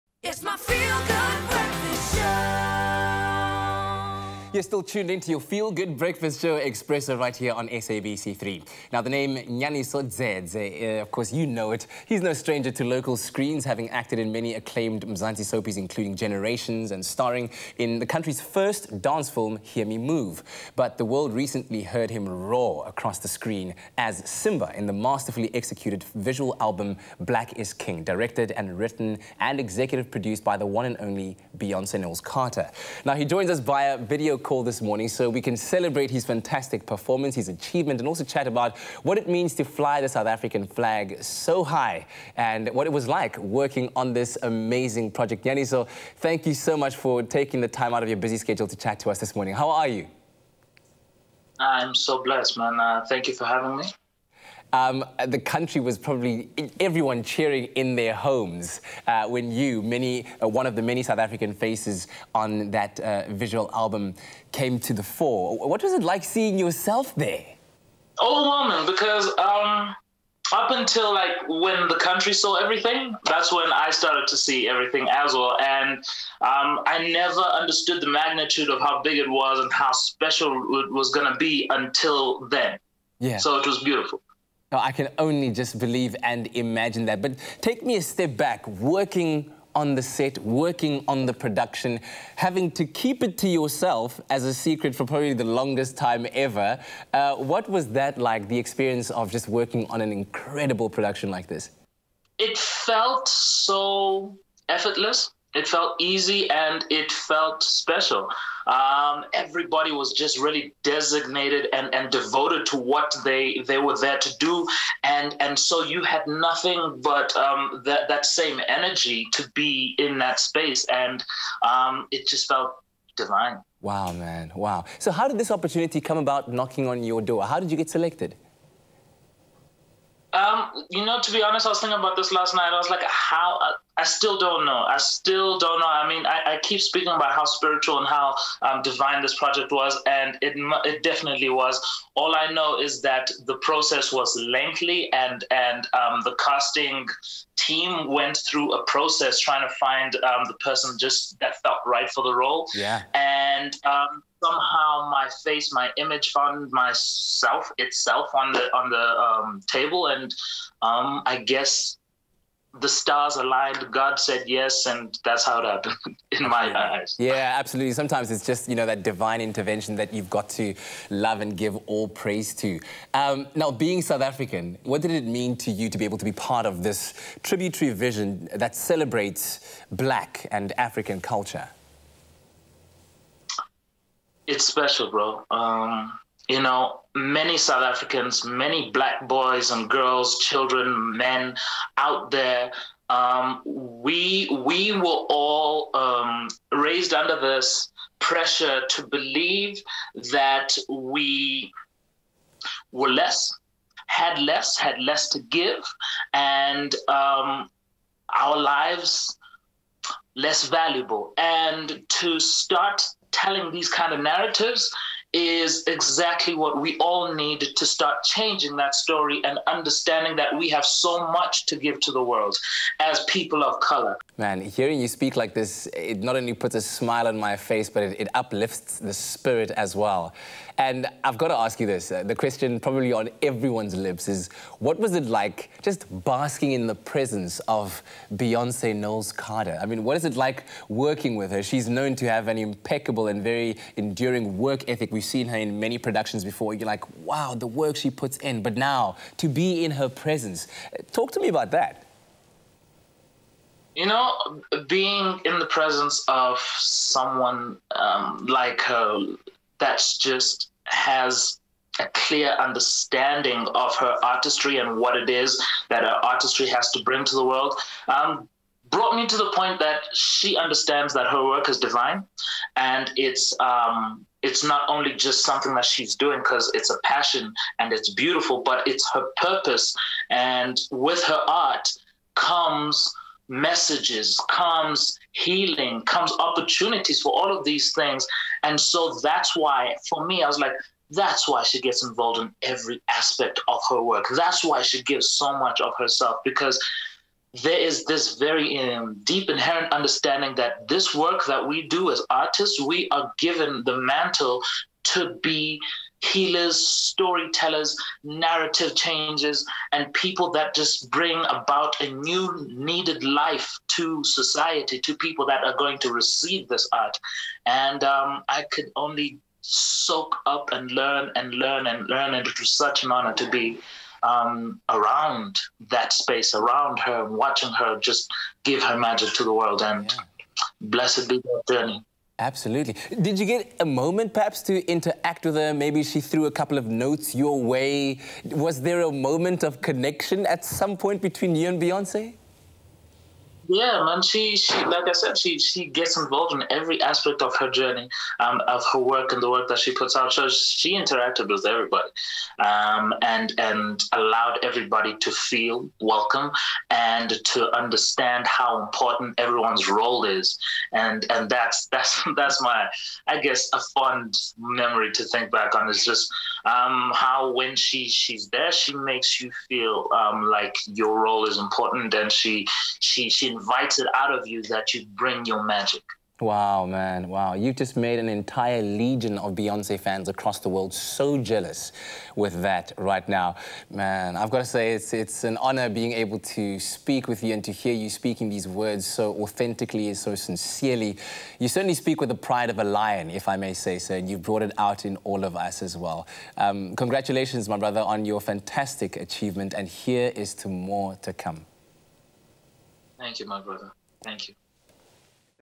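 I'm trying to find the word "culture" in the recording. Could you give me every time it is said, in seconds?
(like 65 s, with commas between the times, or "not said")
181 s.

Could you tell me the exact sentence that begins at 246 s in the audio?
You're like, wow, the work she puts in.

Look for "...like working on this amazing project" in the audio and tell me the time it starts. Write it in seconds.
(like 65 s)
43 s.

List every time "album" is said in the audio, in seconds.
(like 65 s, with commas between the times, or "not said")
26 s, 63 s.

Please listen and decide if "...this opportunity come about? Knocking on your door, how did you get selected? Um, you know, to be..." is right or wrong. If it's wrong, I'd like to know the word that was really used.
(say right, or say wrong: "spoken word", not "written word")
right.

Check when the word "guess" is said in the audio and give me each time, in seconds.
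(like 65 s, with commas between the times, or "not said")
161 s, 363 s.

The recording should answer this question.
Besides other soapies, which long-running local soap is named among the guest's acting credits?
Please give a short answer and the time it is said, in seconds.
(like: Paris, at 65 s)
Generations, at 16 s.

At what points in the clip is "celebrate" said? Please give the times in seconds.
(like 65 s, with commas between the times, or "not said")
35 s, 178 s.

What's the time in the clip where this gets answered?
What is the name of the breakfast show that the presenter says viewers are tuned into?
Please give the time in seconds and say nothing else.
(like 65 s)
5 s.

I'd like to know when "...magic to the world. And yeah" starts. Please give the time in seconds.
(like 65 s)
328 s.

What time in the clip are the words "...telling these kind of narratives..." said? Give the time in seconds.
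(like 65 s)
213 s.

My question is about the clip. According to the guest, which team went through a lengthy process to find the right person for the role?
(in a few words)
The casting team.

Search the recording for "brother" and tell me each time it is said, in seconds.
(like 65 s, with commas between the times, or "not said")
397 s, 403 s.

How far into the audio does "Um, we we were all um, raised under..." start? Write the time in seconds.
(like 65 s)
193 s.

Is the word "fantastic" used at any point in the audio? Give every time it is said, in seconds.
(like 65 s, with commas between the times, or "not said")
36 s, 398 s.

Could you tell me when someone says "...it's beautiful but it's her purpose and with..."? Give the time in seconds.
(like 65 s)
277 s.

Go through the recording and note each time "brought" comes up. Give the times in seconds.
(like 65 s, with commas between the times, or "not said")
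268 s, 394 s.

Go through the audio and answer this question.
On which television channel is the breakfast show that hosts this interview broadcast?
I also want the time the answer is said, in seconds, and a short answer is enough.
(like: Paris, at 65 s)
SABC3, at 7 s.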